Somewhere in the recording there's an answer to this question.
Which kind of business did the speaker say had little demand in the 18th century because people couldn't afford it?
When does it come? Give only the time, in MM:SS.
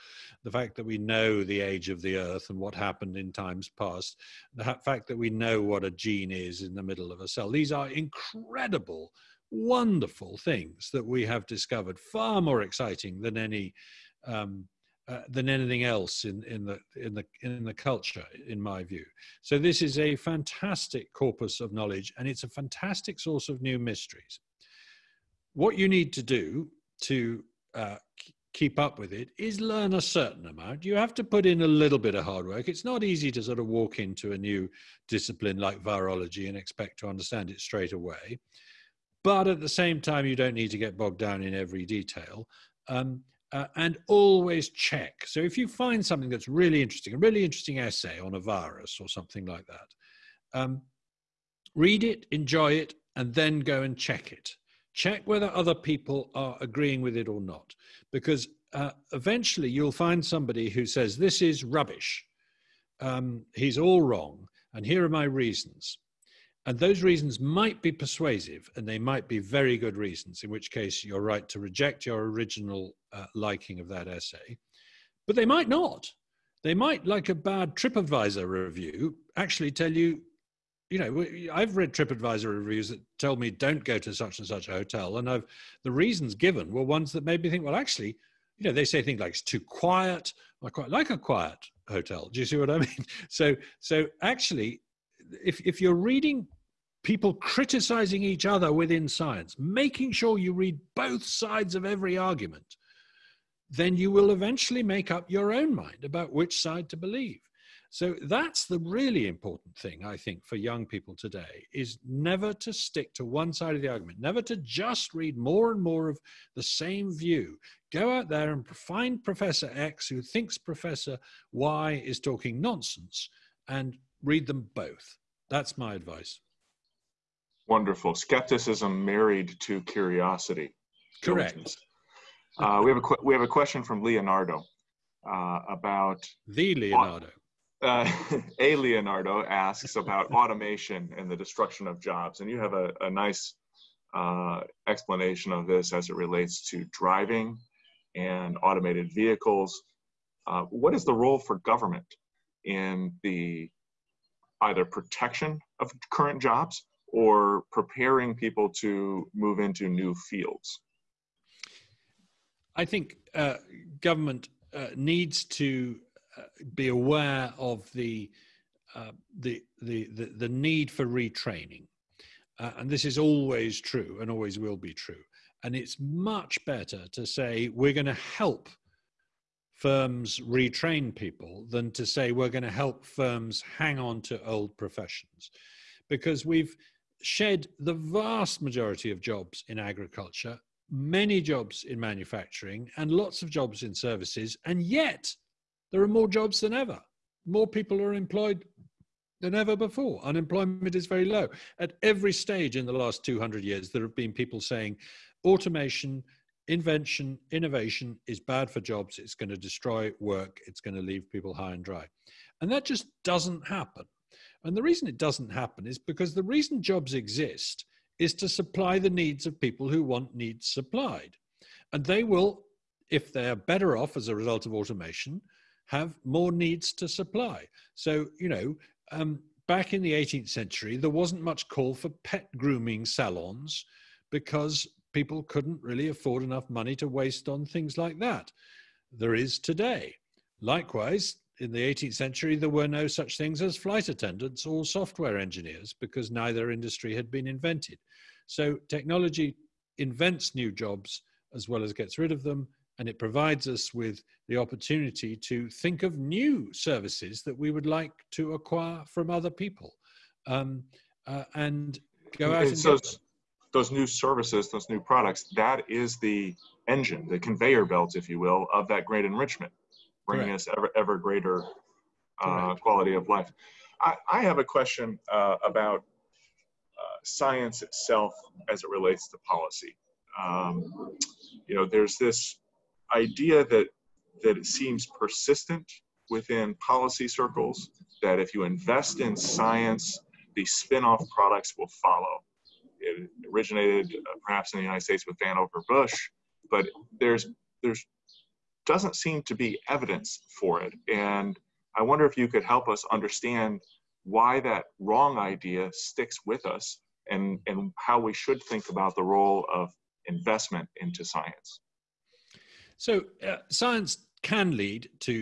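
03:52.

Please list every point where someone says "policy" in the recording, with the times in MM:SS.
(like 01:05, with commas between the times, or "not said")
04:39, 04:46.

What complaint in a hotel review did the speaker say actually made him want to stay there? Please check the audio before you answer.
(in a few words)
too quiet.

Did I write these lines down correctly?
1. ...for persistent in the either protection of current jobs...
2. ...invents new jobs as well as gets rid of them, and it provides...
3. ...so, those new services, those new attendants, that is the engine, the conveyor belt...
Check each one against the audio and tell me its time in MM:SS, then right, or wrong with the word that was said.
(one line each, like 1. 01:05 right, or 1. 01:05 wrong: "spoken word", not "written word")
1. 02:31 wrong: "government", not "persistent"
2. 04:09 right
3. 04:22 wrong: "products", not "attendants".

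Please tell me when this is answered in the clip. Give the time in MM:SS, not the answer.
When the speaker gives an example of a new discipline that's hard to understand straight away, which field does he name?
00:35.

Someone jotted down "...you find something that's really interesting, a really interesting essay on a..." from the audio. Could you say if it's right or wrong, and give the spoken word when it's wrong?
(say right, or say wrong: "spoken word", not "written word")
right.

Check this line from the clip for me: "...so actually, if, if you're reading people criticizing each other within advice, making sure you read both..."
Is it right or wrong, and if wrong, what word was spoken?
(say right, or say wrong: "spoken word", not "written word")
wrong: "science", not "advice".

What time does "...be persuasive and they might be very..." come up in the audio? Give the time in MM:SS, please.
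01:07.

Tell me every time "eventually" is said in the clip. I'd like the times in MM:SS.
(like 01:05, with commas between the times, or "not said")
00:59, 01:44.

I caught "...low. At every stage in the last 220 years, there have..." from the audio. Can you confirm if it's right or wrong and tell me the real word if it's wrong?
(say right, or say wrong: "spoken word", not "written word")
wrong: "200", not "220".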